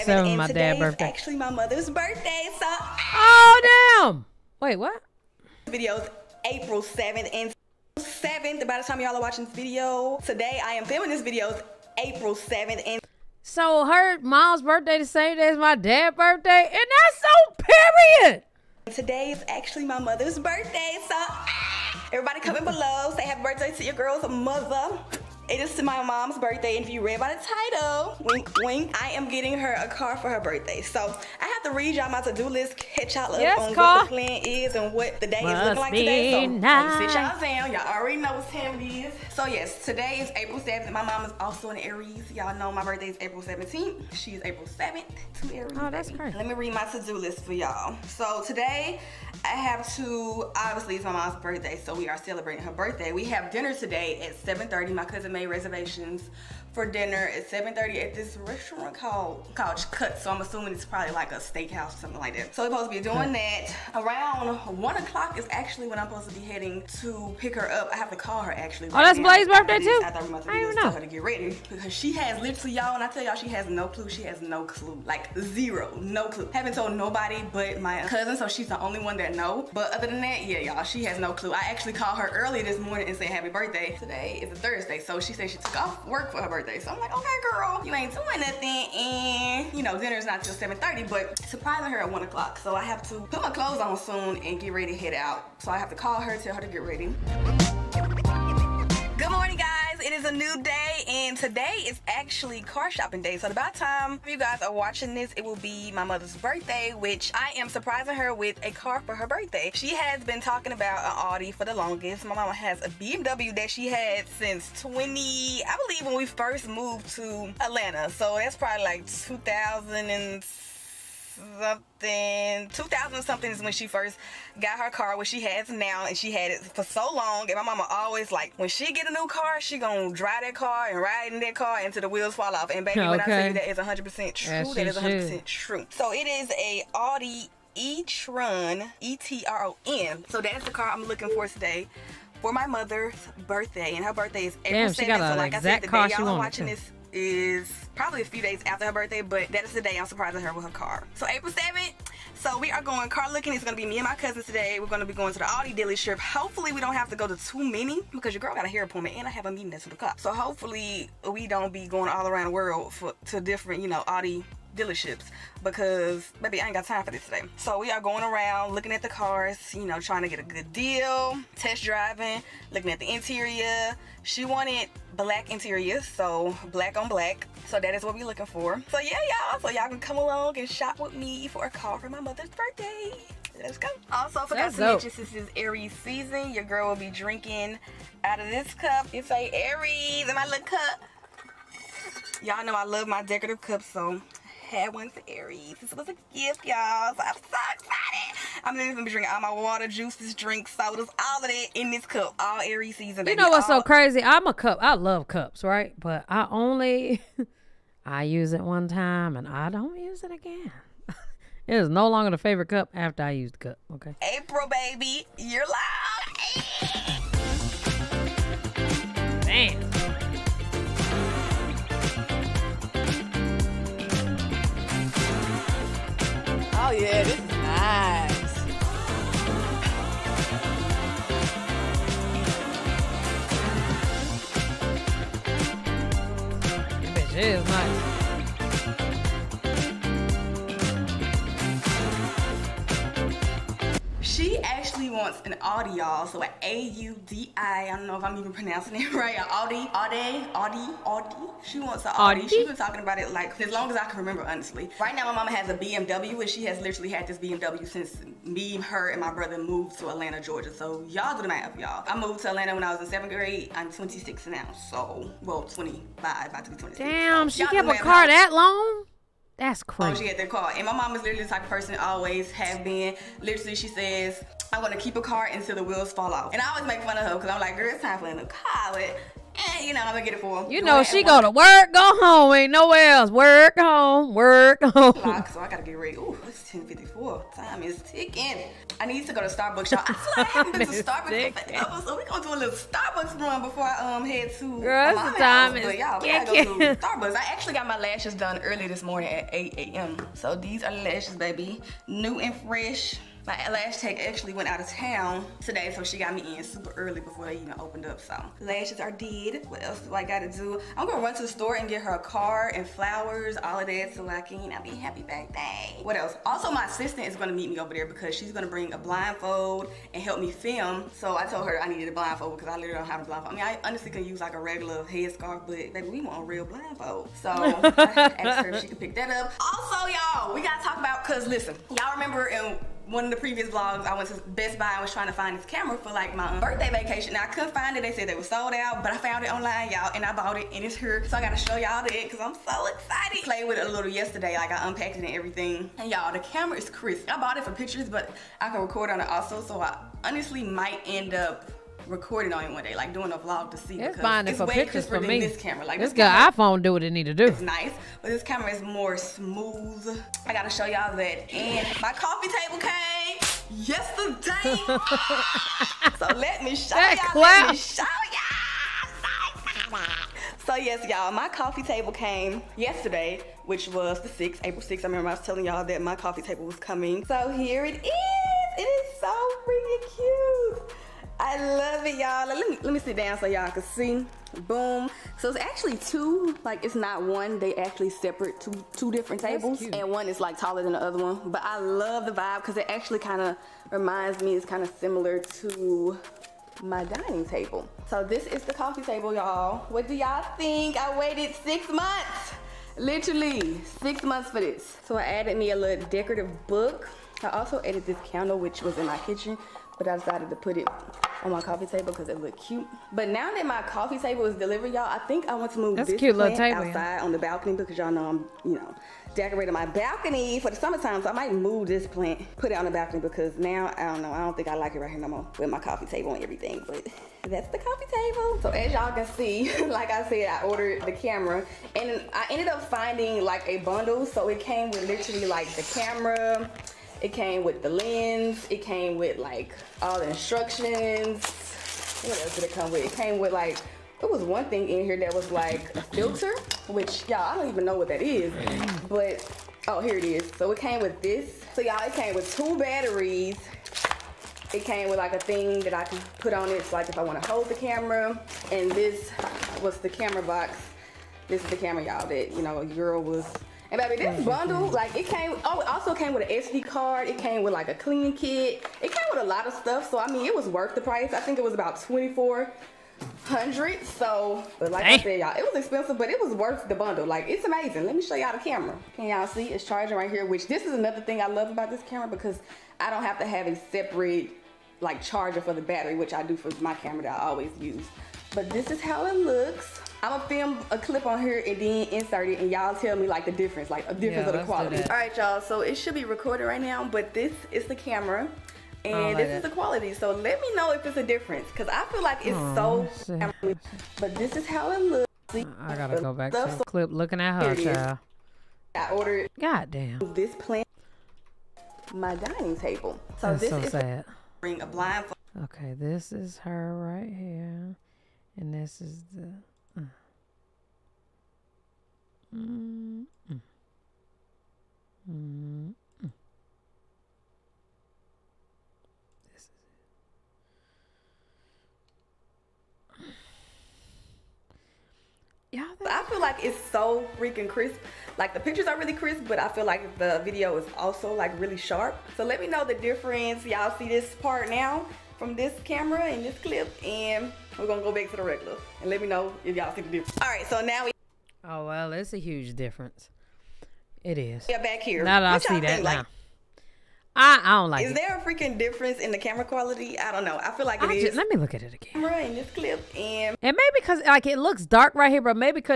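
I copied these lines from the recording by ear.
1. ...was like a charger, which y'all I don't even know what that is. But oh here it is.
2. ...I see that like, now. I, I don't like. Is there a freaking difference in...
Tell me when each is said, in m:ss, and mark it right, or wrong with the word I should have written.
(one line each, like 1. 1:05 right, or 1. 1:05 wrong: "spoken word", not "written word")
1. 7:25 wrong: "filter", not "charger"
2. 9:15 right.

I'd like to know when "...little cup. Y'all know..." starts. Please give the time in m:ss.
3:10.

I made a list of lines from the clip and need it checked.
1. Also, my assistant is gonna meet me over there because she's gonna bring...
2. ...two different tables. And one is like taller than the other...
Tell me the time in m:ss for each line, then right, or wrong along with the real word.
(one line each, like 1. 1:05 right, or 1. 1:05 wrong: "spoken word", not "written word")
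1. 5:16 right
2. 6:28 right.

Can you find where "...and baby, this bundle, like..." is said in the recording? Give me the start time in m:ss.
7:43.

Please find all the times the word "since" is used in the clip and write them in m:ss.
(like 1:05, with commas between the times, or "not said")
1:54, 3:05, 4:17.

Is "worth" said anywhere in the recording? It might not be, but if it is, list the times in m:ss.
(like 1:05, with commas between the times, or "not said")
7:50, 7:56.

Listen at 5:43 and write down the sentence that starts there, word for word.
Played with it a little yesterday.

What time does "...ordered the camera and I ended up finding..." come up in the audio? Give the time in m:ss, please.
7:10.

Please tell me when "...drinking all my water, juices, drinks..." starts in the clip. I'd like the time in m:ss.
3:19.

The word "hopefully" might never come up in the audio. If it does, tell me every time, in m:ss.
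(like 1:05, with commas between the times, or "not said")
2:36, 2:40.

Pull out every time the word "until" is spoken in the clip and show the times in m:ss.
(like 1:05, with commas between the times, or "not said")
2:11, 4:35.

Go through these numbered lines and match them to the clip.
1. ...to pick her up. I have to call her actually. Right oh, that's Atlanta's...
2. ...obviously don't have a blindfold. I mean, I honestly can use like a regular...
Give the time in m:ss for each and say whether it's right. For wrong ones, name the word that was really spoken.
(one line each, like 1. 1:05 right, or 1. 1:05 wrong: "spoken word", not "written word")
1. 1:06 wrong: "Blaze", not "Atlanta"
2. 5:22 wrong: "literally", not "obviously".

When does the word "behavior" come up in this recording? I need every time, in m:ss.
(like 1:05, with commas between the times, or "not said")
not said.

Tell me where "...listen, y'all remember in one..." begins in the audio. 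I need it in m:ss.
5:31.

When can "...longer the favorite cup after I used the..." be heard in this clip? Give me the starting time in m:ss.
3:32.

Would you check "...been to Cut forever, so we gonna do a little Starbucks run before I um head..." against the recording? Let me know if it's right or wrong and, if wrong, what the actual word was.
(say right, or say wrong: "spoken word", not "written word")
wrong: "Starbucks", not "Cut".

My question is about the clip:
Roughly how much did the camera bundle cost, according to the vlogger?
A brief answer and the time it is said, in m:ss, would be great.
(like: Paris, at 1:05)
$2,400, at 7:52.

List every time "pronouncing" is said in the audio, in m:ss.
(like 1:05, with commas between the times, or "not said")
4:08.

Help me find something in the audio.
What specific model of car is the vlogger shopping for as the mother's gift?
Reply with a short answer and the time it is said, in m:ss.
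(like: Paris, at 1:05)
Audi e-tron, at 2:16.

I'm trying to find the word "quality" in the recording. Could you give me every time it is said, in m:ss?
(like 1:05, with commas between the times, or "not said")
8:14, 8:19, 9:19.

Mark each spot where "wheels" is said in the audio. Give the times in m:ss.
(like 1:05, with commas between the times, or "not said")
2:12, 4:35.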